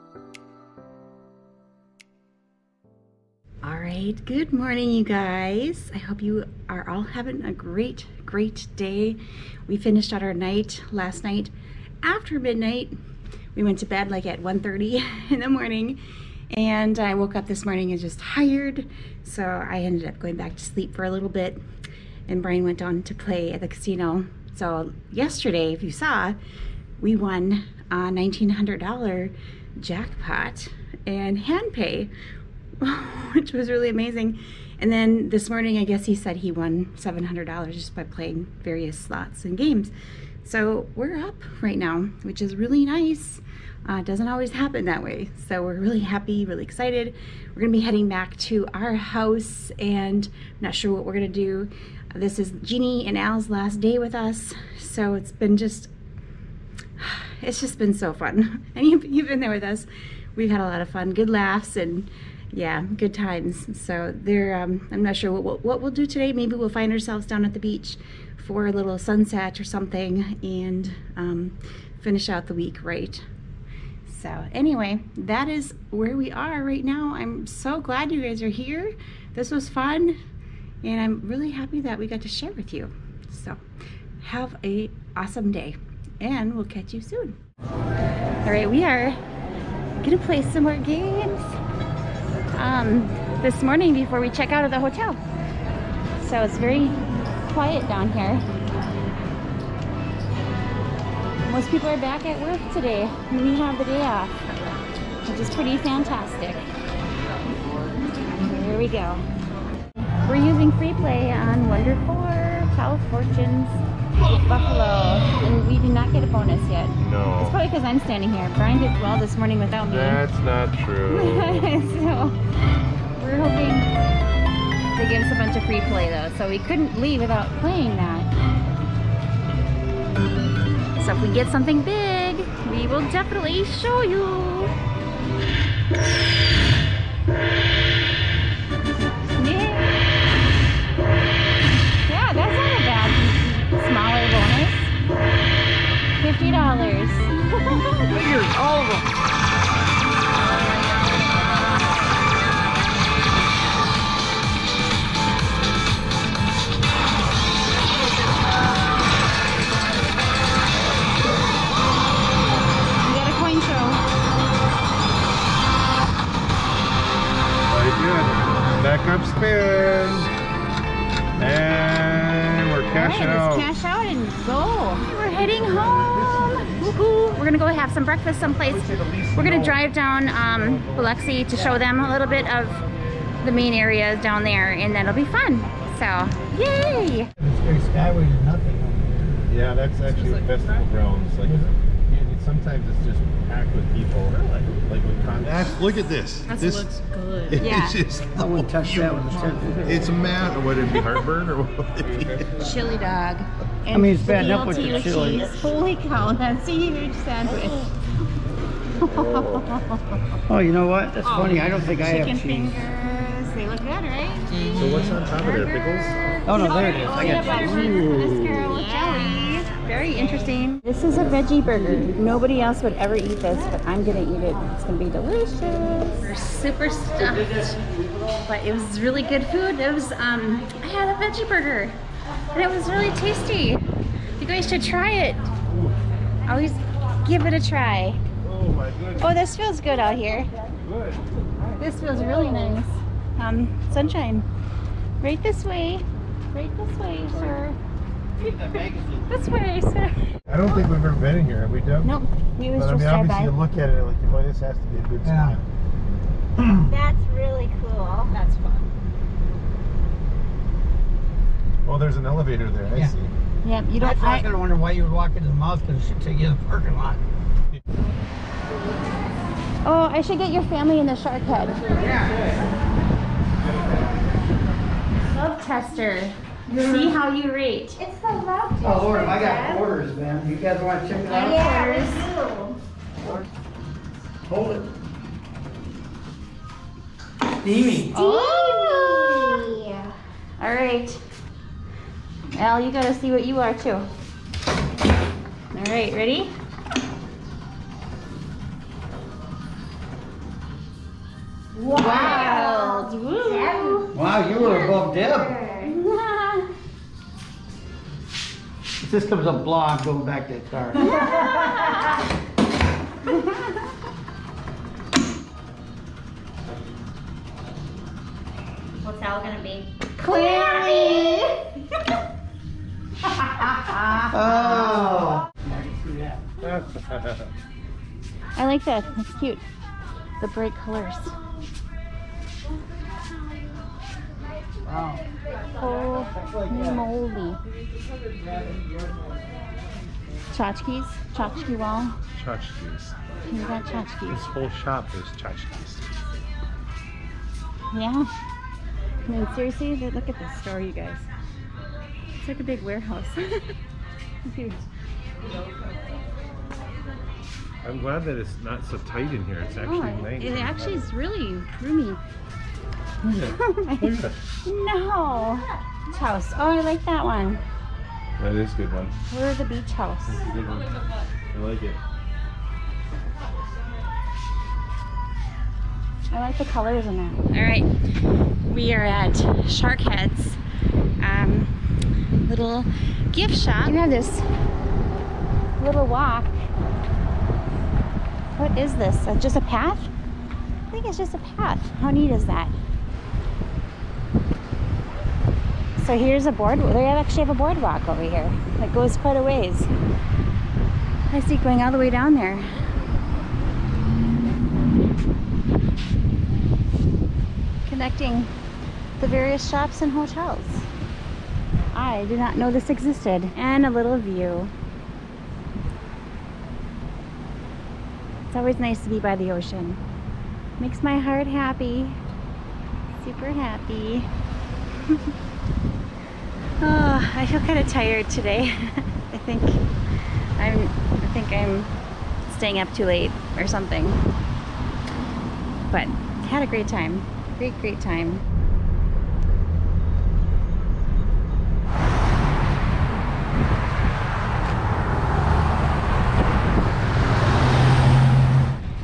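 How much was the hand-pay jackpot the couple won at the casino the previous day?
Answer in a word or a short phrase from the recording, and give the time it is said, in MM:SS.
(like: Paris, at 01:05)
$1900, at 00:27.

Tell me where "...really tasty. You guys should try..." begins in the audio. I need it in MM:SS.
03:52.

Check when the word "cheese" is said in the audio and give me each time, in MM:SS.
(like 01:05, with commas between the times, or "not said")
03:25, 03:32, 03:37.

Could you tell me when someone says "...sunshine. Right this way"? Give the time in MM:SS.
04:03.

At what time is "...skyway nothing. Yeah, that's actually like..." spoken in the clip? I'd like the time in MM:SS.
03:07.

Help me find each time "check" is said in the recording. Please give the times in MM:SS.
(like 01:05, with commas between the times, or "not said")
01:34, 04:41.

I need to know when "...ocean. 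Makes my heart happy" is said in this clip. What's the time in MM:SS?
06:59.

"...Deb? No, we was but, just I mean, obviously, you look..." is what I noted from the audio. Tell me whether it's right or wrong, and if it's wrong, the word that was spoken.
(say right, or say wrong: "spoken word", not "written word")
right.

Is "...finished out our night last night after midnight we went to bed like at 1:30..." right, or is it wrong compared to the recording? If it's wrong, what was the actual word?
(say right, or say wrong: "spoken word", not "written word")
right.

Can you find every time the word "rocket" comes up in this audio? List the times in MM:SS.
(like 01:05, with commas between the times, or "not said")
not said.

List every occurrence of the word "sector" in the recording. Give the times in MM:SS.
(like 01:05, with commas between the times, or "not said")
not said.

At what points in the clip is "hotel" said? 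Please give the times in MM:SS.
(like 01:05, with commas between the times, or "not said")
01:34, 06:50.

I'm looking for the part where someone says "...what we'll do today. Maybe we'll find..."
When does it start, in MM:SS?
01:05.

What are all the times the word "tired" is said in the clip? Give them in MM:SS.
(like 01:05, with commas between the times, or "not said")
00:18, 07:07.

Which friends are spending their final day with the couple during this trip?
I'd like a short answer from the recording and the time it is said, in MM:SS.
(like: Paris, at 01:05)
Jeannie and Al, at 00:52.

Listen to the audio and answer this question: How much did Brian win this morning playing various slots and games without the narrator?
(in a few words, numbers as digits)
$700.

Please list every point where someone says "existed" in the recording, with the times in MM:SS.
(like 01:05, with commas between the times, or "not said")
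06:52.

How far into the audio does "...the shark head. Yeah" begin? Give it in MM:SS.
04:31.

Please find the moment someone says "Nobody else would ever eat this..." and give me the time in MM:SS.
03:41.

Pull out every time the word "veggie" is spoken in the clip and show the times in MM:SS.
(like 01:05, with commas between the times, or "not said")
03:41, 03:51.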